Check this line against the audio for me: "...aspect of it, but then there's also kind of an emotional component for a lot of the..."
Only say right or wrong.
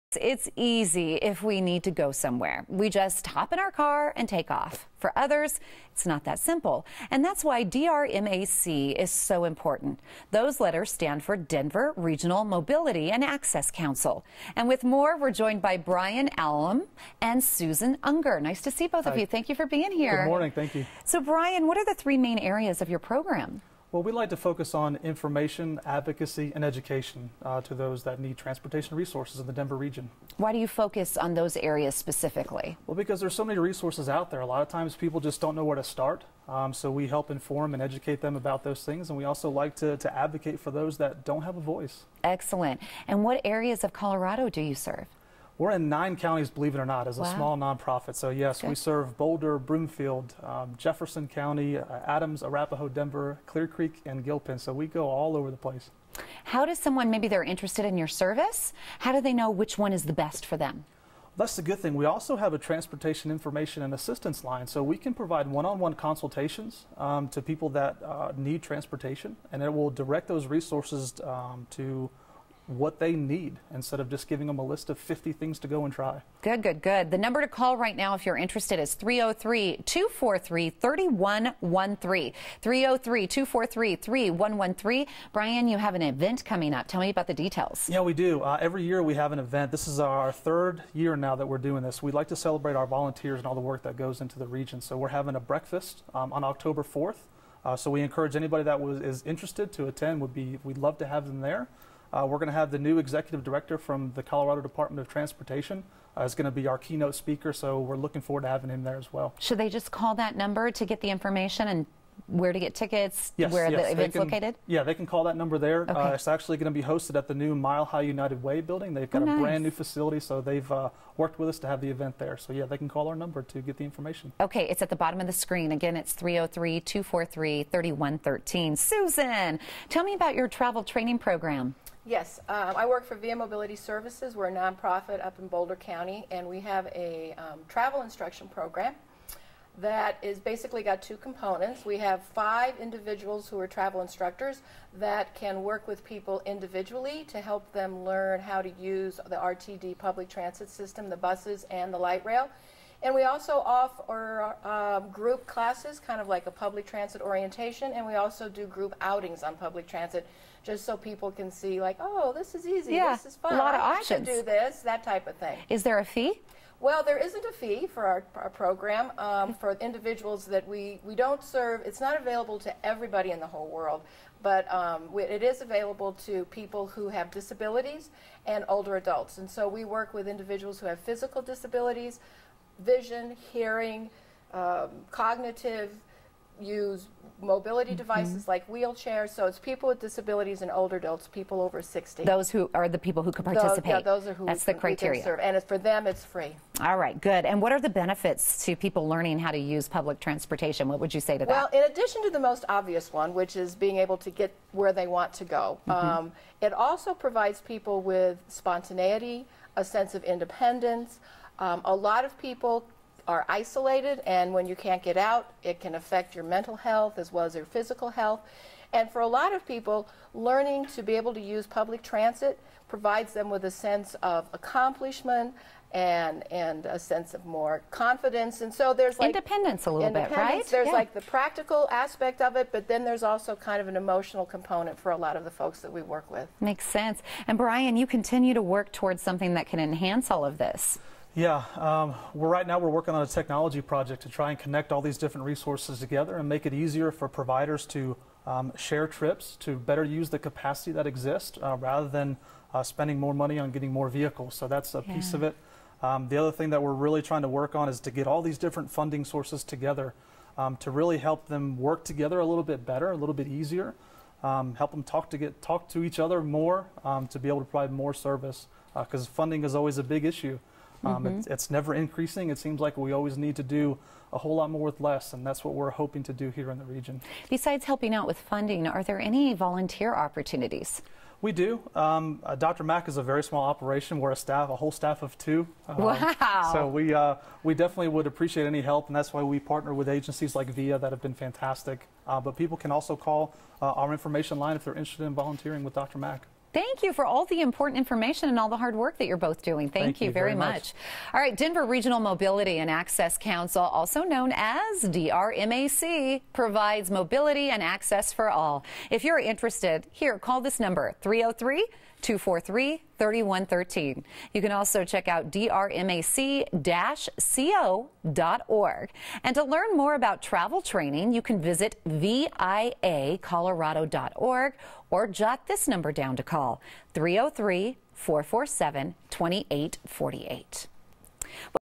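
right.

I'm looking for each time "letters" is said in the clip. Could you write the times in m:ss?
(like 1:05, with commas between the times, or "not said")
0:10.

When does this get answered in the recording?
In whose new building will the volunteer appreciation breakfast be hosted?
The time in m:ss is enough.
1:57.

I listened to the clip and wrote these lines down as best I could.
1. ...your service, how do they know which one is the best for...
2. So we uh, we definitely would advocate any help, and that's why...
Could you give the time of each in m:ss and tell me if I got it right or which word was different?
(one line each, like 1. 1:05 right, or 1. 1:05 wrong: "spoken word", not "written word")
1. 0:57 right
2. 4:46 wrong: "appreciate", not "advocate".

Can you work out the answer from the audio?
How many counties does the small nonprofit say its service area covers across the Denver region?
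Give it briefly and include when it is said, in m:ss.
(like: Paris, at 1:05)
9, at 0:45.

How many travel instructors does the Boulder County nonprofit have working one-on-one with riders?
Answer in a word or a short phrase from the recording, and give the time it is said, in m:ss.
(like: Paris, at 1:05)
5, at 2:22.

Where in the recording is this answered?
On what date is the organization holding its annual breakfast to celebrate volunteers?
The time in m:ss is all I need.
1:36.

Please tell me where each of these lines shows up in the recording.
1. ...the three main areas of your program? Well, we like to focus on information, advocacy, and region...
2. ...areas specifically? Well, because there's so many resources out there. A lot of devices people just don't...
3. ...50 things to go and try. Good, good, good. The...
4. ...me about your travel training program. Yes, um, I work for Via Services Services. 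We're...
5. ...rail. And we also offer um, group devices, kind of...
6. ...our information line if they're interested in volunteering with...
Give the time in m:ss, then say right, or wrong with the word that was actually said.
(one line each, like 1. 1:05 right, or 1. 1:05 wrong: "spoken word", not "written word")
1. 0:21 wrong: "education", not "region"
2. 0:31 wrong: "times", not "devices"
3. 1:14 right
4. 2:10 wrong: "Mobility", not "Services"
5. 2:32 wrong: "classes", not "devices"
6. 4:54 right.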